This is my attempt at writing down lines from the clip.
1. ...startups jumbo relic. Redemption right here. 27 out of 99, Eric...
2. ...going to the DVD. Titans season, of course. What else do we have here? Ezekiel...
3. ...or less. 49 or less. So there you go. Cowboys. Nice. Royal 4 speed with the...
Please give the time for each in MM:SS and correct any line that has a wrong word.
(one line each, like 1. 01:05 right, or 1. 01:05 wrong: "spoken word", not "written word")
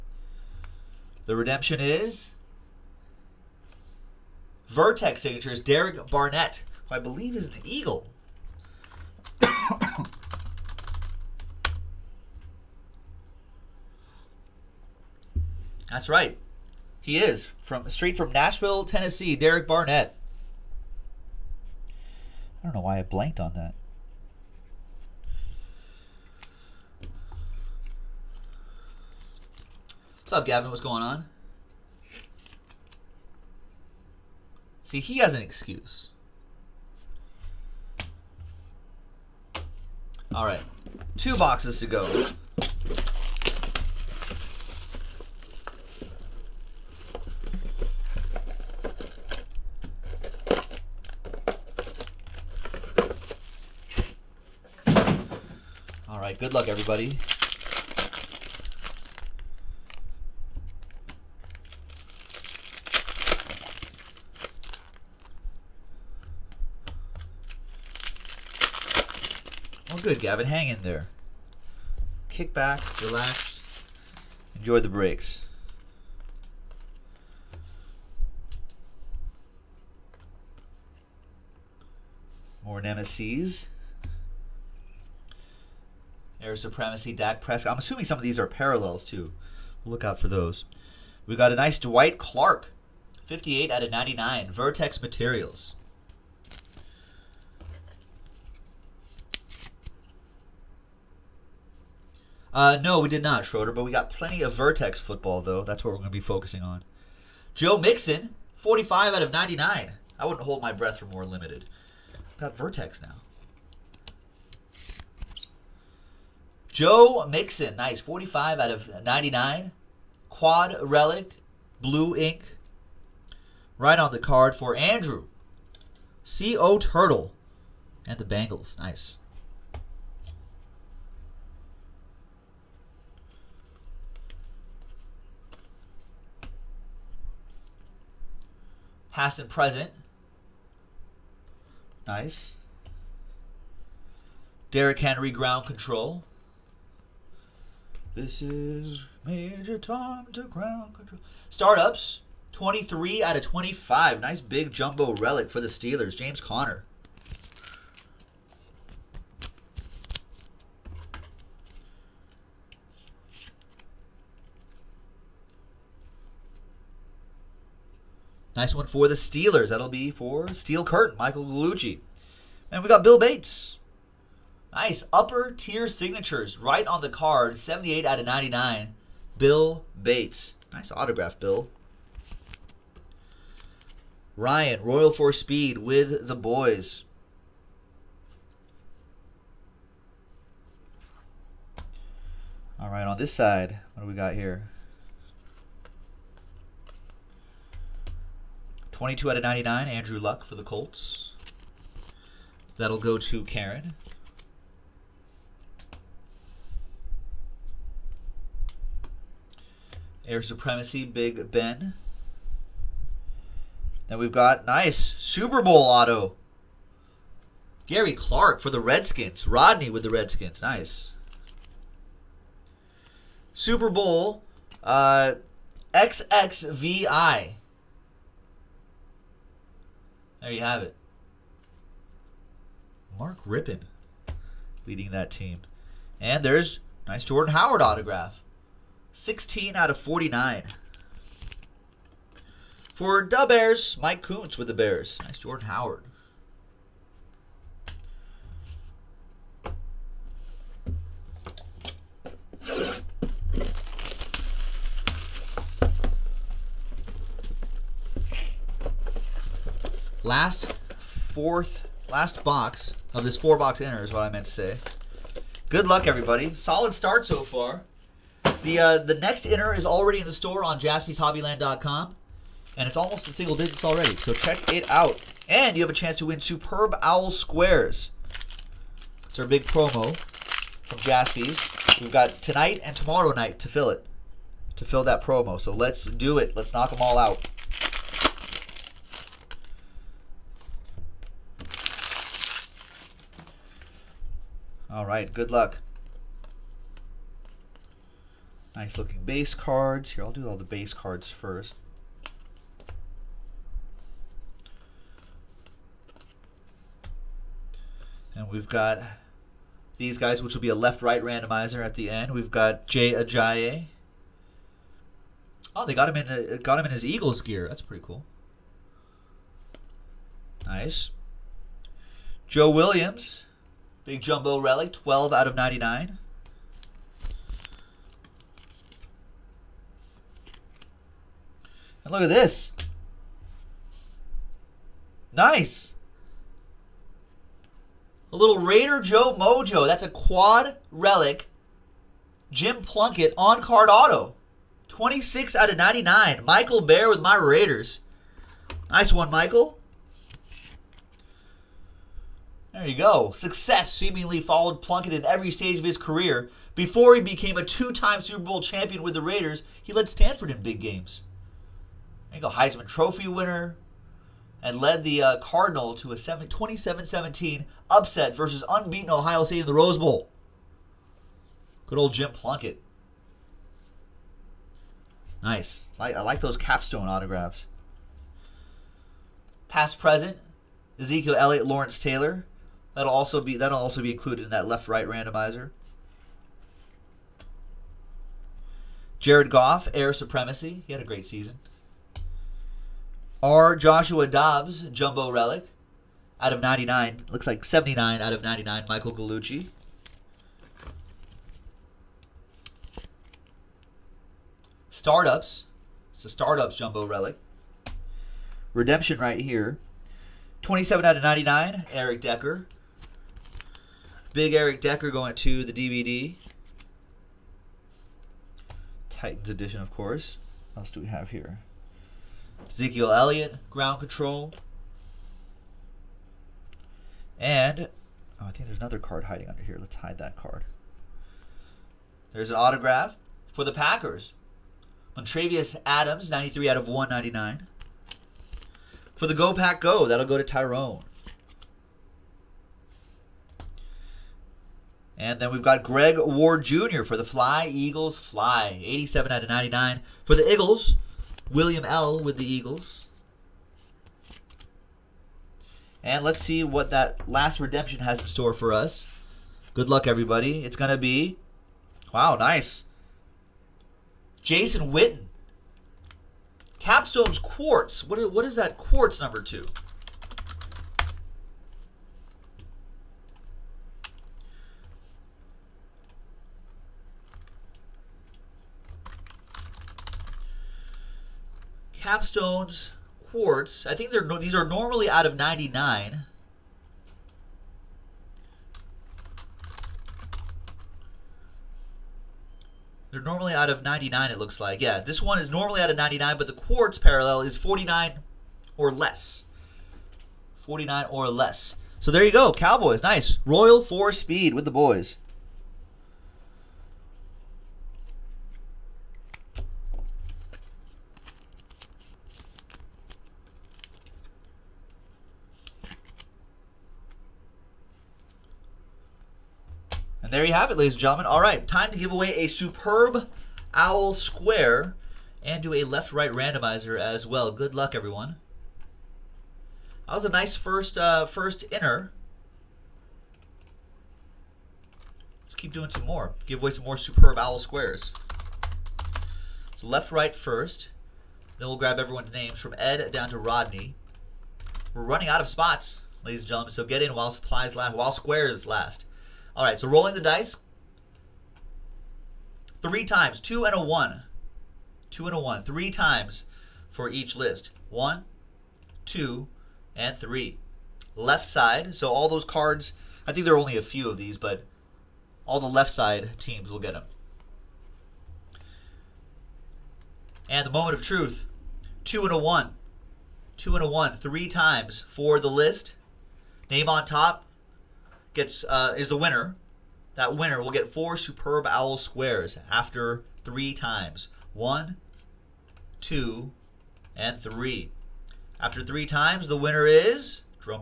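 1. 06:46 right
2. 06:55 wrong: "edition", not "season"
3. 08:18 right.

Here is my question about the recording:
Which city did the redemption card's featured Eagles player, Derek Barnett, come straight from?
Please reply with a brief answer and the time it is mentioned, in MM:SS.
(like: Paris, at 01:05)
Nashville, Tennessee, at 00:18.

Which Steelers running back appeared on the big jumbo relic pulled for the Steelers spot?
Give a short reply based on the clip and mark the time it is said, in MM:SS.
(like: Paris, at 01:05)
James Conner, at 02:36.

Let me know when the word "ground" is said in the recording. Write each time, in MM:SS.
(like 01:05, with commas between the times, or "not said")
02:25, 02:30, 07:03.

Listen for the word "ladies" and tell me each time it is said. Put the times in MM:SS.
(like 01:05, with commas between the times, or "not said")
08:40, 09:06.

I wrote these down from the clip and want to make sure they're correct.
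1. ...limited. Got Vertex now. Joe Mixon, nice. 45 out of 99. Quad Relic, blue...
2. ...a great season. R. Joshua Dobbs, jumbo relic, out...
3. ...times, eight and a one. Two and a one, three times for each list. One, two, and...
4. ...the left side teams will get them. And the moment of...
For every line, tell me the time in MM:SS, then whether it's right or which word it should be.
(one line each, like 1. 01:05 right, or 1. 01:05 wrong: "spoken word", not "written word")
1. 01:51 right
2. 06:31 right
3. 09:13 wrong: "two", not "eight"
4. 09:25 right.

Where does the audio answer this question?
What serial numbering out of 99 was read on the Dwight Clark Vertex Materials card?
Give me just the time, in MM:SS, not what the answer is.
01:33.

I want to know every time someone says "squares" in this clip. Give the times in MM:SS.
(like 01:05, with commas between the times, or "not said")
04:37, 08:44, 08:57, 09:08, 09:41.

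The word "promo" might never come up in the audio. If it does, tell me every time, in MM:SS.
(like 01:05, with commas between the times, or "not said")
04:39, 04:45.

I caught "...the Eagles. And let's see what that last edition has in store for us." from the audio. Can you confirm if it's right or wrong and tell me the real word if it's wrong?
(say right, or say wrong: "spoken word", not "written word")
wrong: "redemption", not "edition".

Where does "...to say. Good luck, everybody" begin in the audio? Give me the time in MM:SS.
04:24.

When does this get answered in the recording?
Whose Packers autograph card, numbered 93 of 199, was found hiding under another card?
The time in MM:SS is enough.
07:15.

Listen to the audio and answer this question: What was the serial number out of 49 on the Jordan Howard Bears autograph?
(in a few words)
16.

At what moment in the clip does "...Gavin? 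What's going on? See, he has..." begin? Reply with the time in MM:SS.
00:30.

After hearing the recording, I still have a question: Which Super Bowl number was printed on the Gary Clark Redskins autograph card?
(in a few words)
XXVI.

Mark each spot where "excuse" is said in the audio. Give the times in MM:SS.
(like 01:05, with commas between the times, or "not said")
00:35.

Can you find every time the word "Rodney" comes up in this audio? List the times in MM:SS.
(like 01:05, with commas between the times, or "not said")
03:39, 09:03.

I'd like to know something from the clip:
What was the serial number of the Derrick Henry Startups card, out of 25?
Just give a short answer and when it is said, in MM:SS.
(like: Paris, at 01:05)
23, at 02:32.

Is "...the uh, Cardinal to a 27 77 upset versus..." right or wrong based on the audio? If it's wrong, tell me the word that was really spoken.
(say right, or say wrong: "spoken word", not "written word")
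wrong: "17", not "77".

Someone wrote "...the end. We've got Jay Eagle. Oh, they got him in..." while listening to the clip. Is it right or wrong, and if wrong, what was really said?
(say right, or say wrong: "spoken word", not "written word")
wrong: "Ajayi", not "Eagle".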